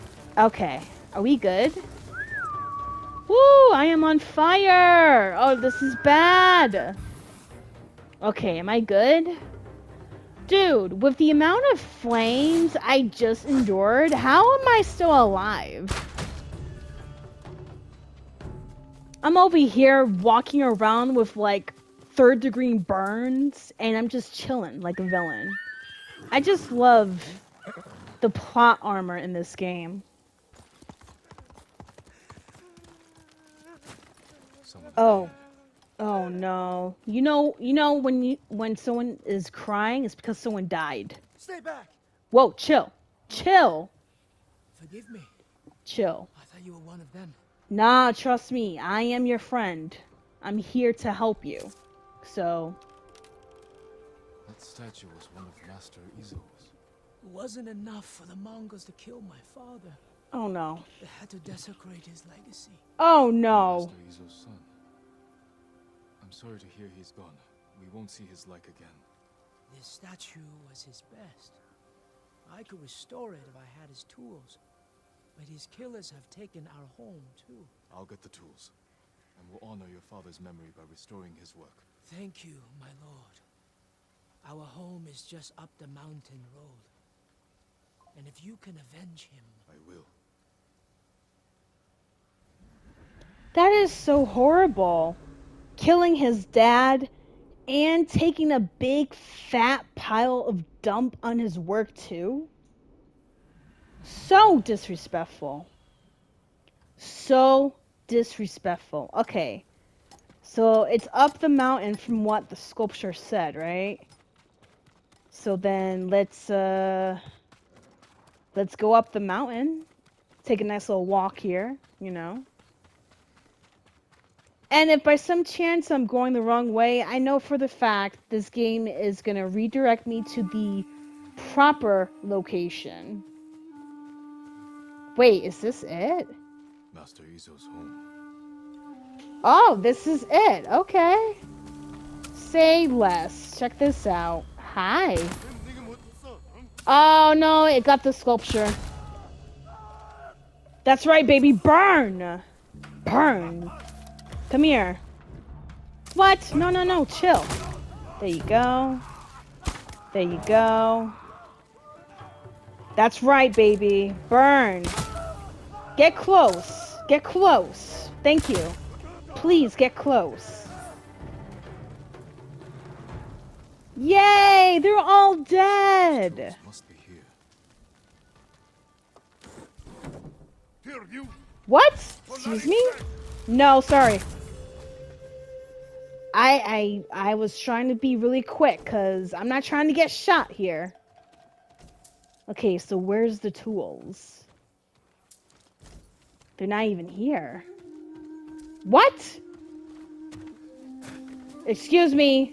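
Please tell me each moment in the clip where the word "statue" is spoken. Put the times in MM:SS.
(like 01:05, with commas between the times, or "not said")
00:54, 01:09.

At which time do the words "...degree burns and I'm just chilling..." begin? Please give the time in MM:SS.
00:22.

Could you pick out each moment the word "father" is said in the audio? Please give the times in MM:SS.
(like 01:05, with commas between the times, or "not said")
00:59, 01:20.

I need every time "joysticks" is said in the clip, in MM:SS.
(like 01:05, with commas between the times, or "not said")
not said.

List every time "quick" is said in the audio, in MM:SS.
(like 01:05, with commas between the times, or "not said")
03:08.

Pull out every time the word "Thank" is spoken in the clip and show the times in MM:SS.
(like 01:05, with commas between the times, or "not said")
01:22, 02:48.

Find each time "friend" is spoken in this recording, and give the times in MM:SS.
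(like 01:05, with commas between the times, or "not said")
00:49.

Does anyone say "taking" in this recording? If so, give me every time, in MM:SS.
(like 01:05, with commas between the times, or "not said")
01:38.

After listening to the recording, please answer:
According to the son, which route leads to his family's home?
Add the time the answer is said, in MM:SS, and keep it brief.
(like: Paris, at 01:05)
the mountain road, at 01:25.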